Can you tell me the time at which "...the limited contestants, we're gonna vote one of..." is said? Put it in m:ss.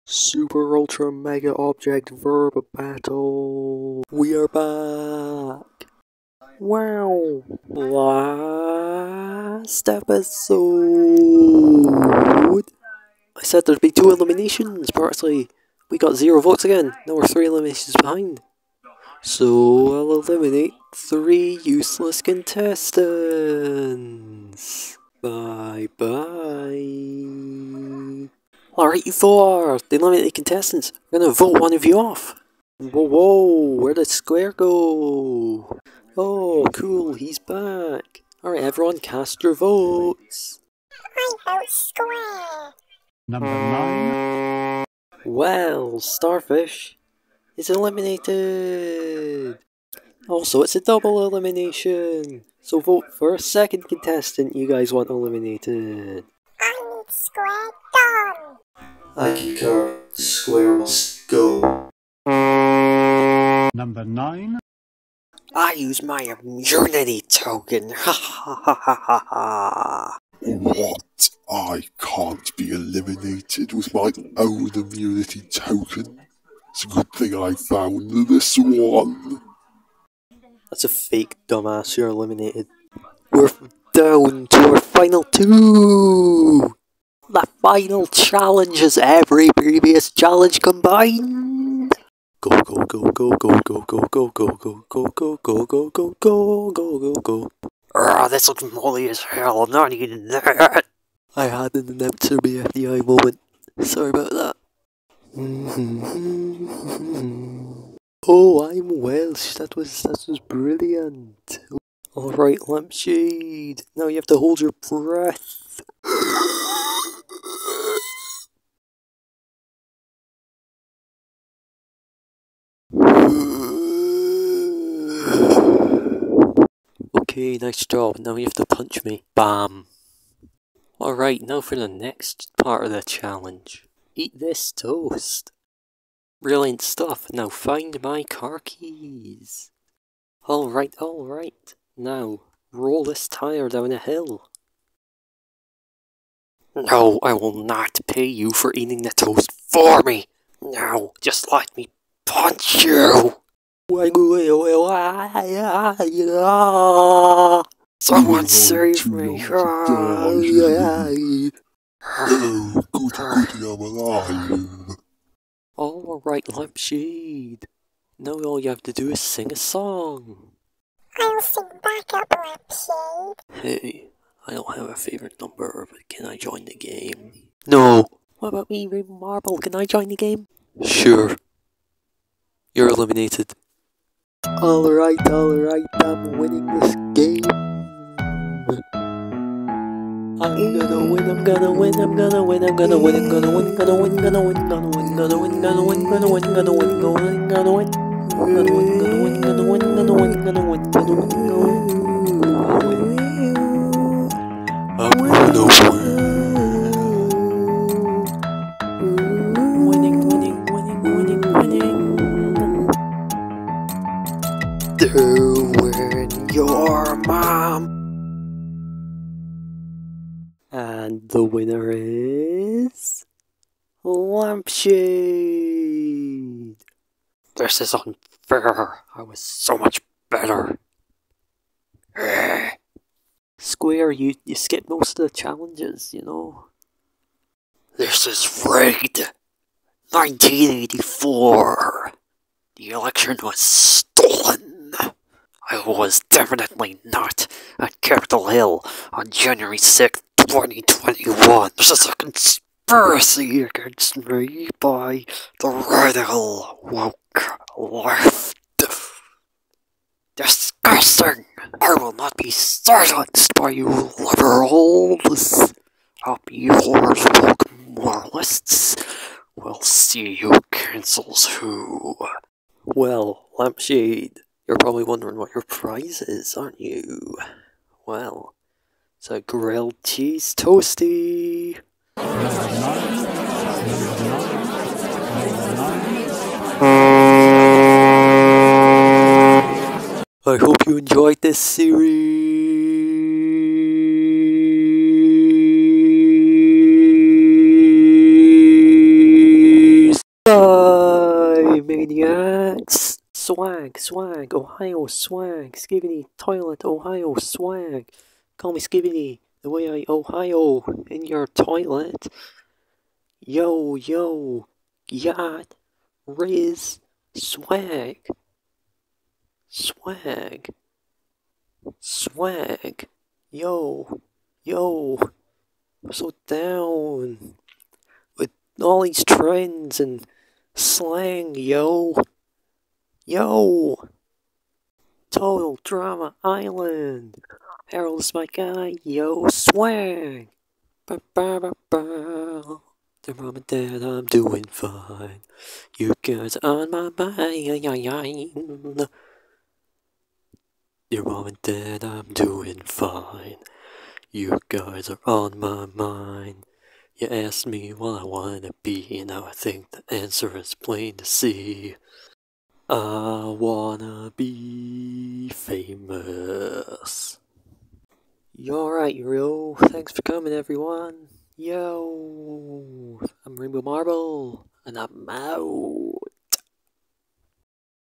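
0:29.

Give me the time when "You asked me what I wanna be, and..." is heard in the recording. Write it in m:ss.
5:57.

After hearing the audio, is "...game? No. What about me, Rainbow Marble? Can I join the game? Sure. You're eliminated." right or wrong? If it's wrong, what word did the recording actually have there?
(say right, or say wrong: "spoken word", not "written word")
right.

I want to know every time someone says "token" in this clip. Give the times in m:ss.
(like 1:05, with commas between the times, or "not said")
1:07, 1:15.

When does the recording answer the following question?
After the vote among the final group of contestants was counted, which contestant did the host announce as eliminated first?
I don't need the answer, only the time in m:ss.
0:45.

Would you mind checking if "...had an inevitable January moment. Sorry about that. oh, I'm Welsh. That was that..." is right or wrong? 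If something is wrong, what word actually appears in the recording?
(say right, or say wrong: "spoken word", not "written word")
wrong: "FBI", not "January".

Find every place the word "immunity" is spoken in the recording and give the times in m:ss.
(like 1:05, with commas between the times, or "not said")
1:06, 1:14.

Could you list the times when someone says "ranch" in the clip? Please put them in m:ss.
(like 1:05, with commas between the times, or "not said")
not said.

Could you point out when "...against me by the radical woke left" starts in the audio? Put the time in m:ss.
4:13.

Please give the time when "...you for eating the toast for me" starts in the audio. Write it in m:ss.
2:28.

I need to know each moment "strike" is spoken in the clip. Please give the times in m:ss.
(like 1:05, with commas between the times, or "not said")
not said.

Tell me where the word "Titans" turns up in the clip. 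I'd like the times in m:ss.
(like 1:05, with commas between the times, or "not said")
not said.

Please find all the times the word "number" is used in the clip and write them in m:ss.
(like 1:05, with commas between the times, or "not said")
0:43, 1:03, 2:55.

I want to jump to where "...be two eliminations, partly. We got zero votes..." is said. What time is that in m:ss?
0:13.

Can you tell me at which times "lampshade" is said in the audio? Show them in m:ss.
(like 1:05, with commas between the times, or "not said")
1:52, 2:46, 2:52, 3:44, 4:33.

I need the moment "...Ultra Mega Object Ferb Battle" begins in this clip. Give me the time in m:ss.
0:00.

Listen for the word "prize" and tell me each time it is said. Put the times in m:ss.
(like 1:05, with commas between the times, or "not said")
4:35.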